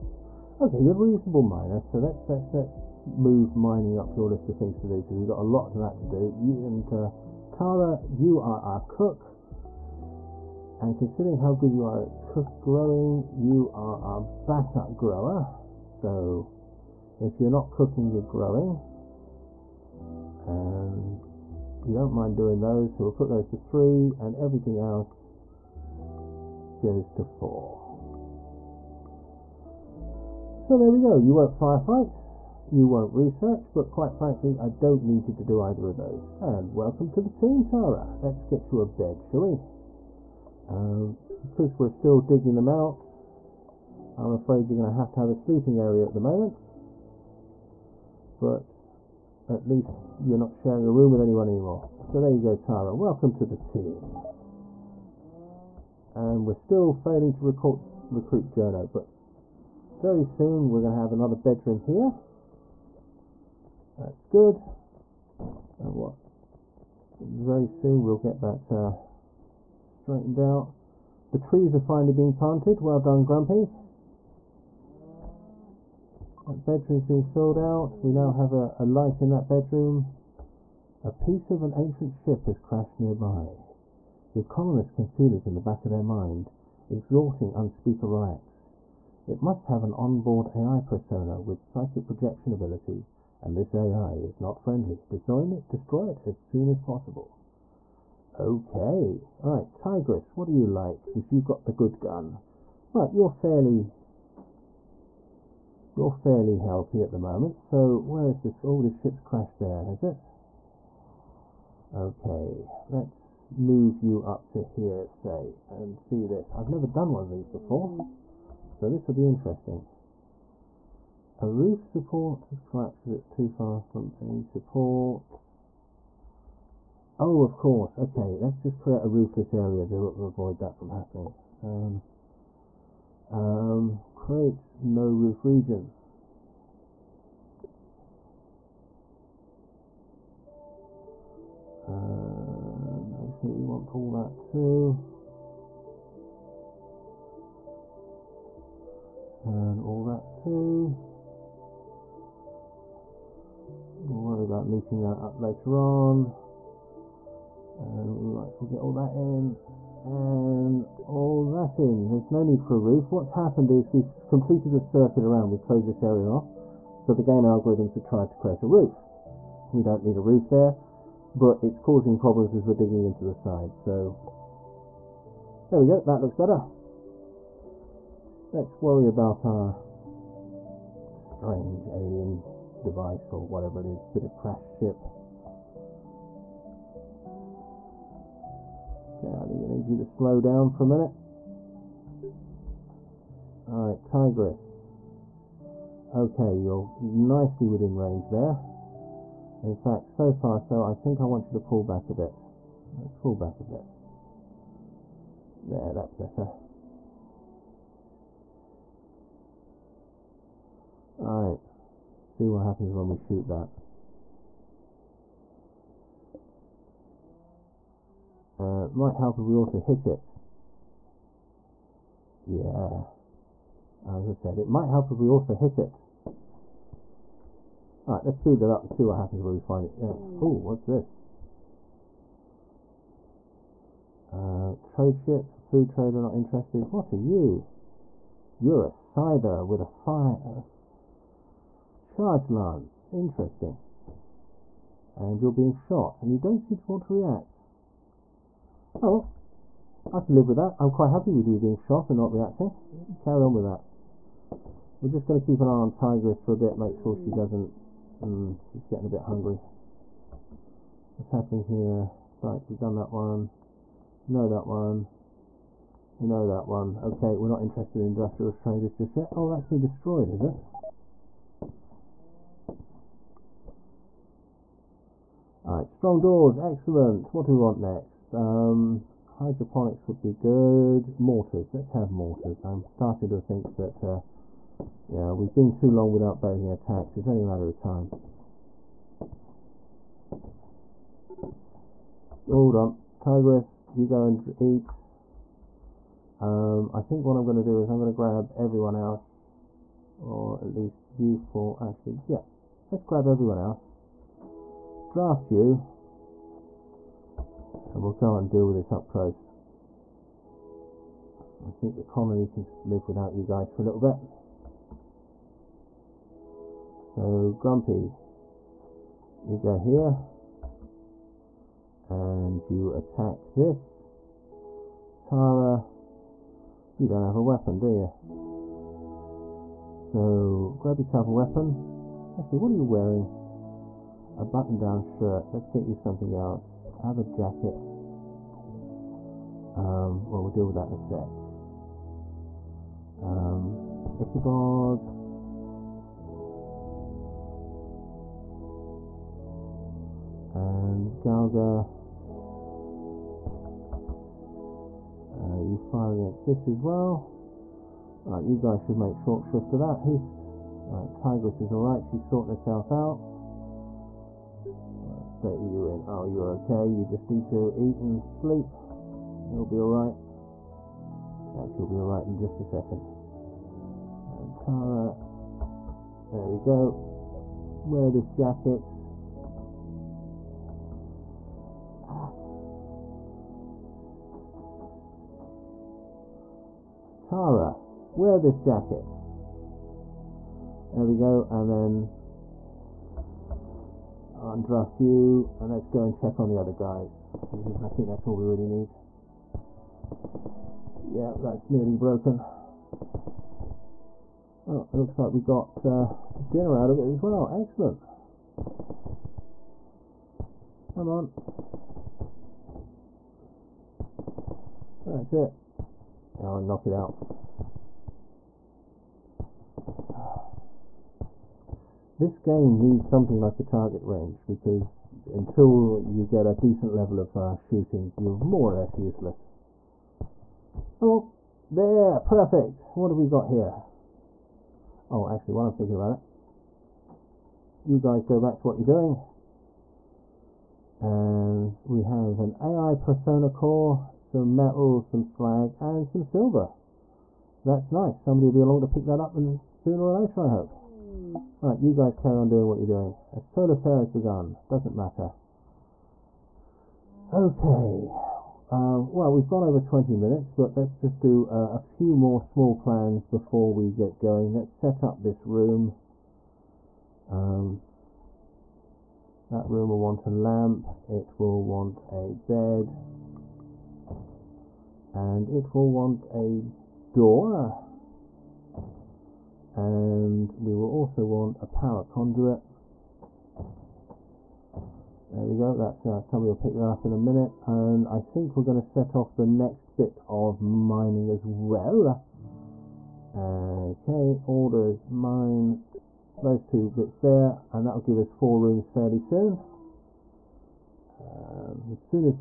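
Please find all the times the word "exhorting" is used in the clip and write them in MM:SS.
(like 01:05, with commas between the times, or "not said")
01:26.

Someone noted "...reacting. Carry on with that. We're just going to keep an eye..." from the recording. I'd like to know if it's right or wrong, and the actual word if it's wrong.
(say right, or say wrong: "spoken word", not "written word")
right.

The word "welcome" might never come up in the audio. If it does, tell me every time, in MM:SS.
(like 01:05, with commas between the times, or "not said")
00:36, 00:52.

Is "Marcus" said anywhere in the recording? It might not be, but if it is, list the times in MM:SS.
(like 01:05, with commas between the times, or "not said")
not said.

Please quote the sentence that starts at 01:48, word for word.
Oh, this ship's crashed there, has it?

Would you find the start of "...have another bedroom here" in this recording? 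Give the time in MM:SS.
01:00.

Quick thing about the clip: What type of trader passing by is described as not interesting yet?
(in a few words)
Industrial traders.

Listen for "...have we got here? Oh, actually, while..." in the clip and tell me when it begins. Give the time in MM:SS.
07:13.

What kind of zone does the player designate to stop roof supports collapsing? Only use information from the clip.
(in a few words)
No roof region.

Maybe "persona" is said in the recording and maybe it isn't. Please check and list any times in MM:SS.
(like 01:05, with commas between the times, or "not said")
01:30, 07:22.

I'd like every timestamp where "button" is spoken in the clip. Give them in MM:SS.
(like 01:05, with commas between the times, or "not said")
05:34.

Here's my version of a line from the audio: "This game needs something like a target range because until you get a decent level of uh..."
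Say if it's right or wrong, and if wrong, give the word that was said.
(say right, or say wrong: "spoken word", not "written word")
right.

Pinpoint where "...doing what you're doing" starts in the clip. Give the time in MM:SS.
07:32.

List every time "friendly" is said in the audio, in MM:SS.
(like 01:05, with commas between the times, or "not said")
01:34.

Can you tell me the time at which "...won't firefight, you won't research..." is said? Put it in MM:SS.
00:31.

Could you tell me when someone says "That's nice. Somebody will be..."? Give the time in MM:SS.
07:27.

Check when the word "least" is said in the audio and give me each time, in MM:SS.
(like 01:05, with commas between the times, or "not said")
00:49, 05:00.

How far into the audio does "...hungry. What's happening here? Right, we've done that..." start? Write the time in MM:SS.
04:19.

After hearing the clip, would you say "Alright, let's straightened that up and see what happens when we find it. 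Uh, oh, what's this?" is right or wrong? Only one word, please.
wrong.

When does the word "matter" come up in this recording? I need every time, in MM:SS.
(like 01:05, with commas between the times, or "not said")
04:47, 07:34.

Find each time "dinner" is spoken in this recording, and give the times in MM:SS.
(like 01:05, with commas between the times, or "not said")
06:46.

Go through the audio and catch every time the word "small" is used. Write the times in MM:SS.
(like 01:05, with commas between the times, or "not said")
07:42.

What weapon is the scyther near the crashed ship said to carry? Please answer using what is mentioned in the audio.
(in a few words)
Fire charge lance.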